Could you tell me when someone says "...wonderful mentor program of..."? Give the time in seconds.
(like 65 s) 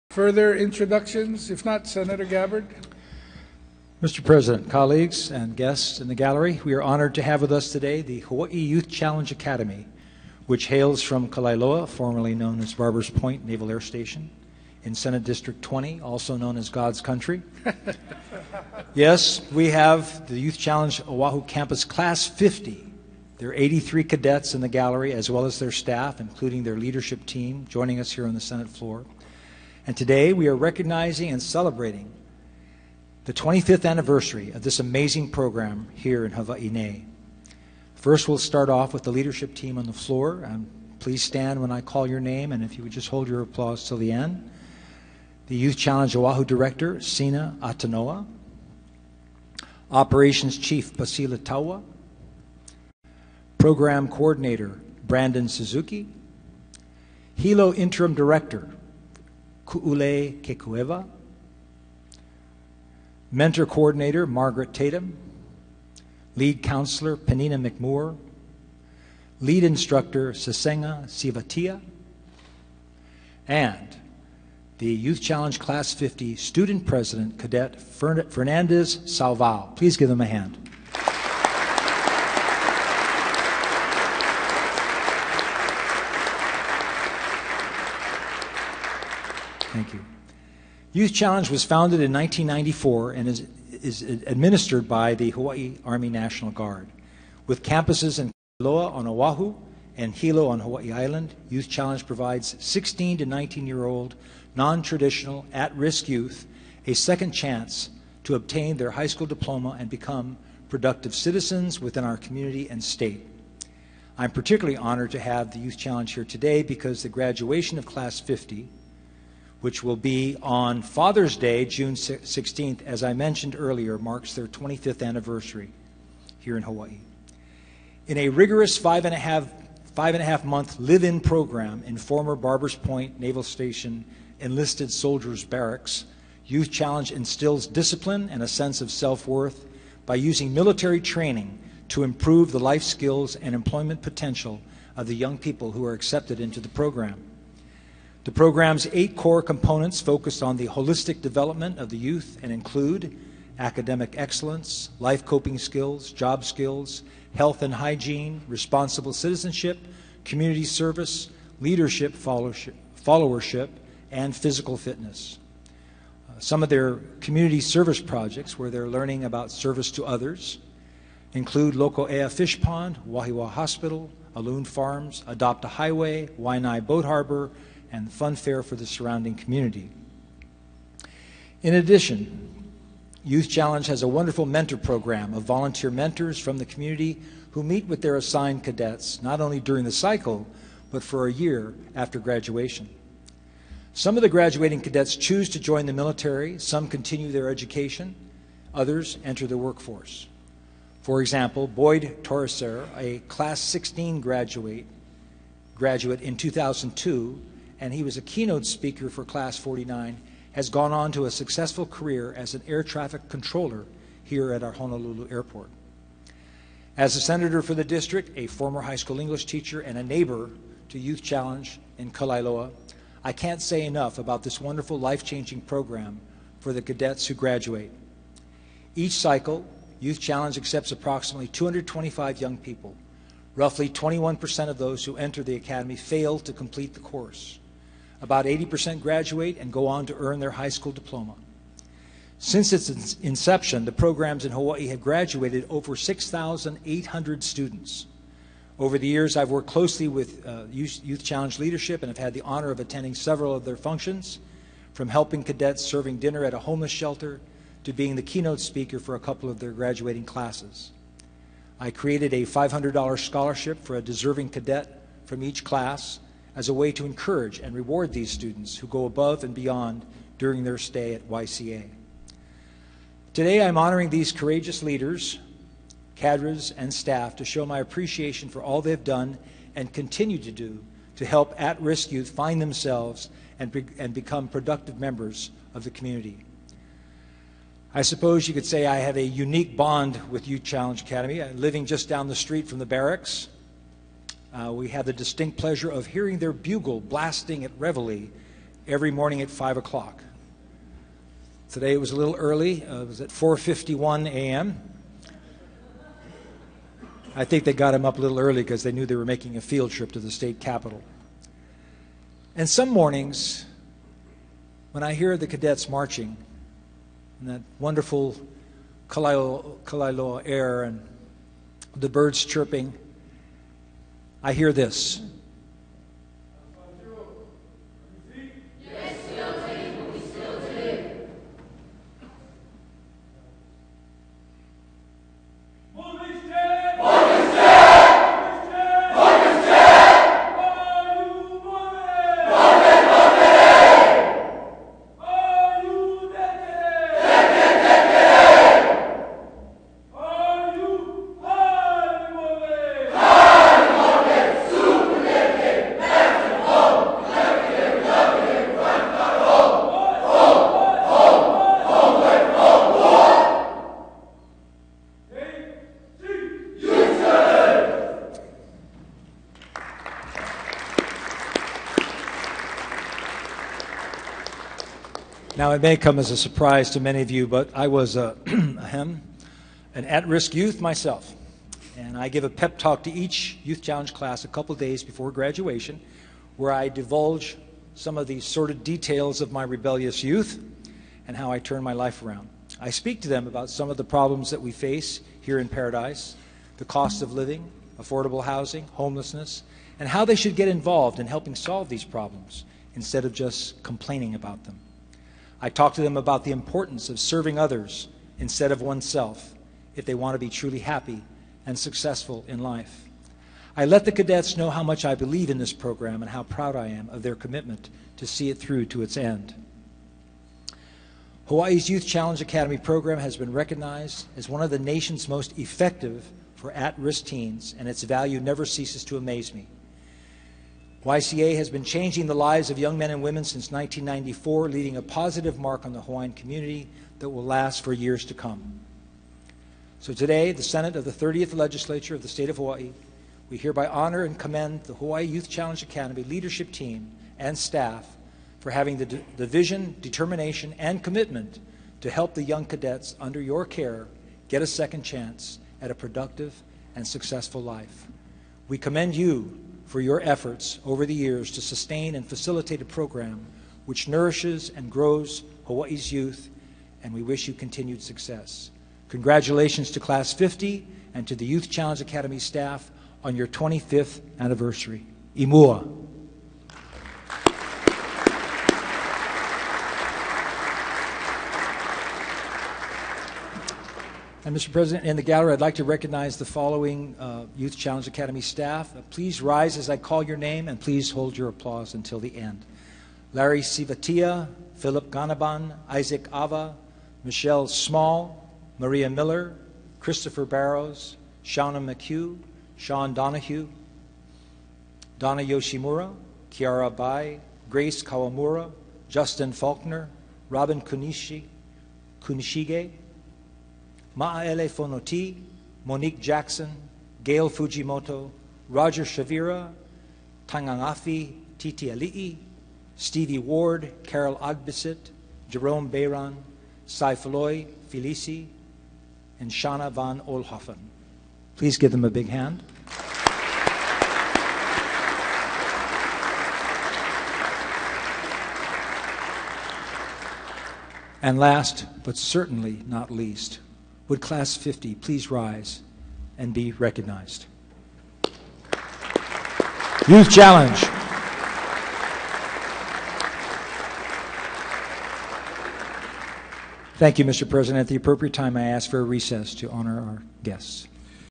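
184 s.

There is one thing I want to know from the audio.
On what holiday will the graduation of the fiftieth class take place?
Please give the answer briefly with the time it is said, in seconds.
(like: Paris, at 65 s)
Father's Day, at 120 s.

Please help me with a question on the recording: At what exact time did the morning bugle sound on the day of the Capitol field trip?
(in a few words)
4:51 a.m.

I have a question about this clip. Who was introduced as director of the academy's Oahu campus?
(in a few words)
Sina Atanoa.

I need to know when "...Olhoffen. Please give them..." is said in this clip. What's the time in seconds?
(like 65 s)
530 s.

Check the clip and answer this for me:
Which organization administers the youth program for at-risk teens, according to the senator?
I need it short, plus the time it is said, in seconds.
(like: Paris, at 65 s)
Hawaii Army National Guard, at 95 s.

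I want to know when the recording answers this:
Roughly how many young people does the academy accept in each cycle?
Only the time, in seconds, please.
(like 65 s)
231 s.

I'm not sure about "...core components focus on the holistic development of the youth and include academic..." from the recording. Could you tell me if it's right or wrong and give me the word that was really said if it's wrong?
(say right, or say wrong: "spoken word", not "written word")
right.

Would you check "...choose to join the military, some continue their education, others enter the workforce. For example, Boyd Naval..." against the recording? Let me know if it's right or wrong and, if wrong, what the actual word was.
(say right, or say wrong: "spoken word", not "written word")
wrong: "Torreser", not "Naval".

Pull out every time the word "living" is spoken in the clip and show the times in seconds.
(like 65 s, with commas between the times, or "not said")
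291 s, 397 s.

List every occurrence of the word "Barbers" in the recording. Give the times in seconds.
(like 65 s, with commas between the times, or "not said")
12 s, 132 s.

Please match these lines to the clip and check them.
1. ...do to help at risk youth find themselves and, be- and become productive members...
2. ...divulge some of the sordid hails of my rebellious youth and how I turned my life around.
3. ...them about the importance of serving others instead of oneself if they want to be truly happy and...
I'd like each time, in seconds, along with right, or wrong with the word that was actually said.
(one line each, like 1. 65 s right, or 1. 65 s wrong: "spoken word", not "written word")
1. 280 s right
2. 386 s wrong: "details", not "hails"
3. 406 s right.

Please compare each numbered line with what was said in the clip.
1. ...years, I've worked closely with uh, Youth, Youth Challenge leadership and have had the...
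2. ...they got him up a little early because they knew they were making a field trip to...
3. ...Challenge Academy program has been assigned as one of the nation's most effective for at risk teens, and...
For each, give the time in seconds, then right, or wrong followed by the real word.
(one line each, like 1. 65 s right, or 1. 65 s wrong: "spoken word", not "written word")
1. 249 s right
2. 307 s right
3. 422 s wrong: "recognized", not "assigned".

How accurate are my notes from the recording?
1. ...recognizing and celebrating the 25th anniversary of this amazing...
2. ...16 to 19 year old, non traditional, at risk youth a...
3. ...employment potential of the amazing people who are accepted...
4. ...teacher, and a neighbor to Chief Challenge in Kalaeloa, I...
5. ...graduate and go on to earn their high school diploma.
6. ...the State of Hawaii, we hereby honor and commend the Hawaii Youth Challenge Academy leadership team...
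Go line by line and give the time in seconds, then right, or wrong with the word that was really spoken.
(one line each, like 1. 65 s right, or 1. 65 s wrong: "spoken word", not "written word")
1. 30 s right
2. 102 s right
3. 143 s wrong: "young", not "amazing"
4. 219 s wrong: "Youth", not "Chief"
5. 239 s right
6. 442 s right.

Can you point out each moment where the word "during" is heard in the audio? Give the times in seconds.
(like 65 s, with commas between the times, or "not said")
189 s, 270 s.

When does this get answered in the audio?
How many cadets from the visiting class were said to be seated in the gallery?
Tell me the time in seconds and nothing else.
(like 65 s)
23 s.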